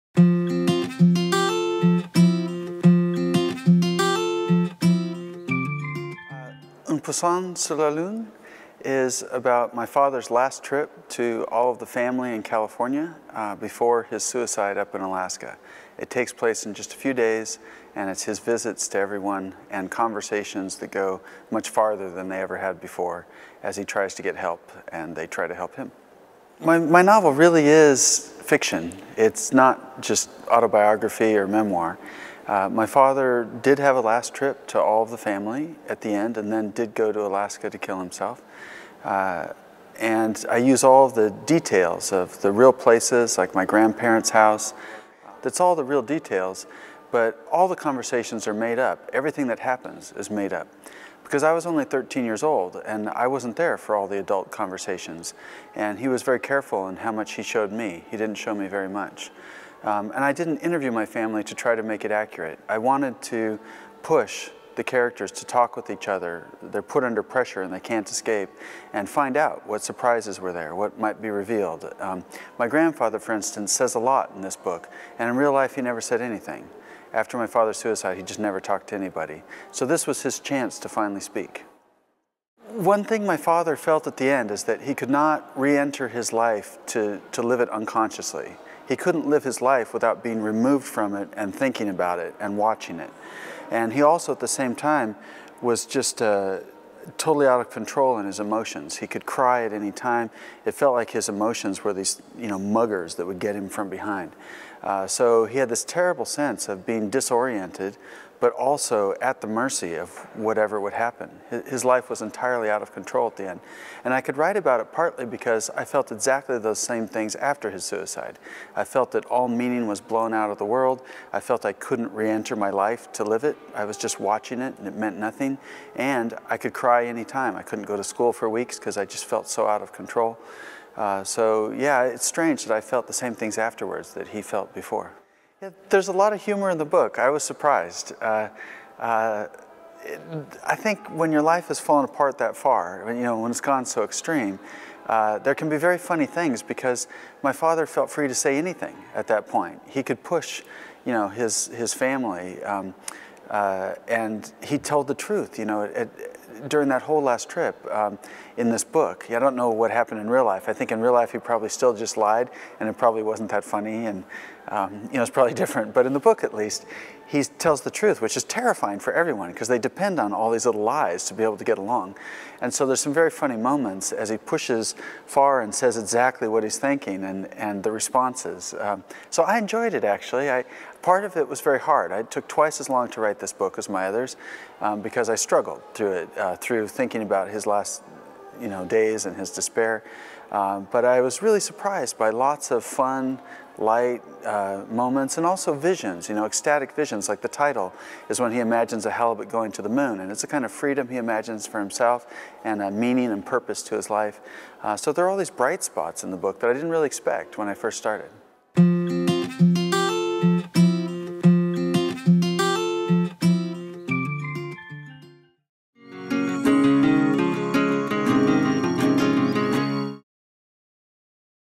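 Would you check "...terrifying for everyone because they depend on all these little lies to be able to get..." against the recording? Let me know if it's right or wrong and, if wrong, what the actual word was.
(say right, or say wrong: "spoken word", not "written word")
right.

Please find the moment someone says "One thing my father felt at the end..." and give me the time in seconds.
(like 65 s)
82 s.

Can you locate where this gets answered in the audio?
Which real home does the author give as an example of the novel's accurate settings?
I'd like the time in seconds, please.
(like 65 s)
43 s.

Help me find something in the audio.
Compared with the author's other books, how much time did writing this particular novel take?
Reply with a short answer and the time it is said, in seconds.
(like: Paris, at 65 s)
twice as long, at 182 s.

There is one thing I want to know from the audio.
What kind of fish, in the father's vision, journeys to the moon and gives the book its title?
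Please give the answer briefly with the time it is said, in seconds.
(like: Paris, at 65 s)
halibut, at 199 s.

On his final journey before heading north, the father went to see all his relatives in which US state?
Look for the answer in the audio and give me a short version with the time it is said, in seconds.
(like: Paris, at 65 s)
California, at 12 s.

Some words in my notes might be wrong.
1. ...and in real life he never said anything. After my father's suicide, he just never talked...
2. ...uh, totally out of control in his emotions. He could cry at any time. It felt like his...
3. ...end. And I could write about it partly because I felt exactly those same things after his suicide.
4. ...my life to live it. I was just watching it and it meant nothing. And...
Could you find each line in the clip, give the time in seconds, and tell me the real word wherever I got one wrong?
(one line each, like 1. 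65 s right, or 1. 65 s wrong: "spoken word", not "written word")
1. 75 s right
2. 96 s right
3. 113 s right
4. 122 s right.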